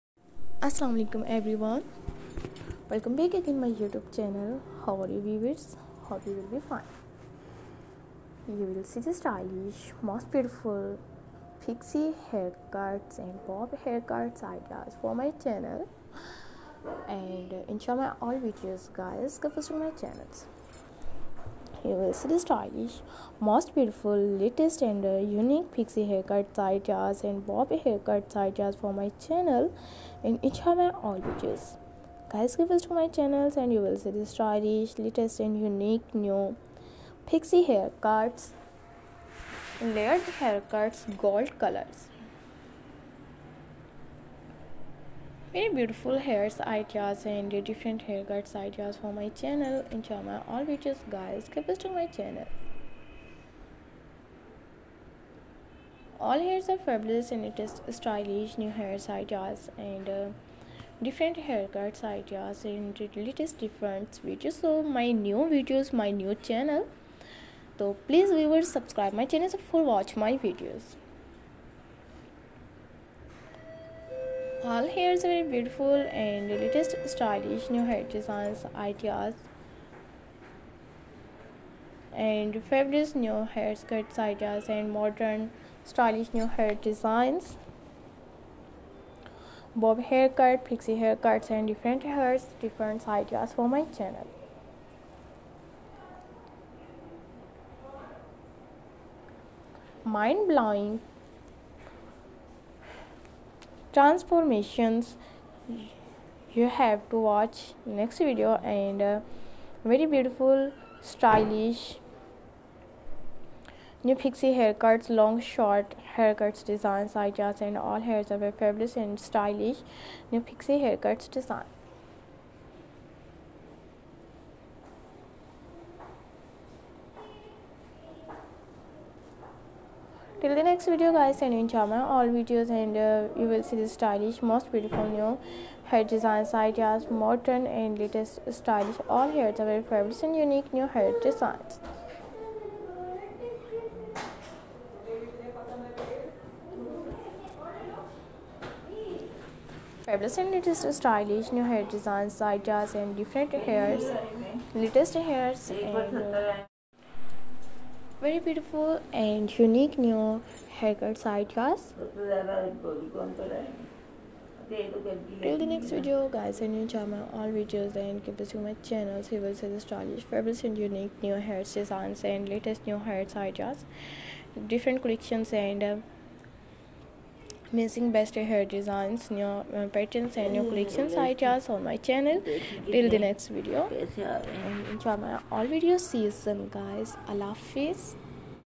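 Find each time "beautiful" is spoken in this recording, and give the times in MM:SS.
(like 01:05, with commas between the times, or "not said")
00:10, 00:23, 00:45, 01:15, 01:50, 02:14, 02:38.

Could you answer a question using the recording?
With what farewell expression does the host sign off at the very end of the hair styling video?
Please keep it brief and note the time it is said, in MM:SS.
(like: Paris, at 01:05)
Allah Hafiz, at 03:07.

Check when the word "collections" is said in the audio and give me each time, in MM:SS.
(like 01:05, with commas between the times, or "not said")
02:55, 03:00.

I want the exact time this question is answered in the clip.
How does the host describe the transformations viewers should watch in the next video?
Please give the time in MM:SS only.
01:40.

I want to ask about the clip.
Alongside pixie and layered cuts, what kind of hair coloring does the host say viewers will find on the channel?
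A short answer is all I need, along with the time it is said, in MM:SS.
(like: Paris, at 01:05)
gold colors, at 00:41.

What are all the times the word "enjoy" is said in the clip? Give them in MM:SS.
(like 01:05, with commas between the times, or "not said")
02:46, 03:04.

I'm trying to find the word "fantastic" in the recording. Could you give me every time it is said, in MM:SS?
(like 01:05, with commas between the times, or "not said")
not said.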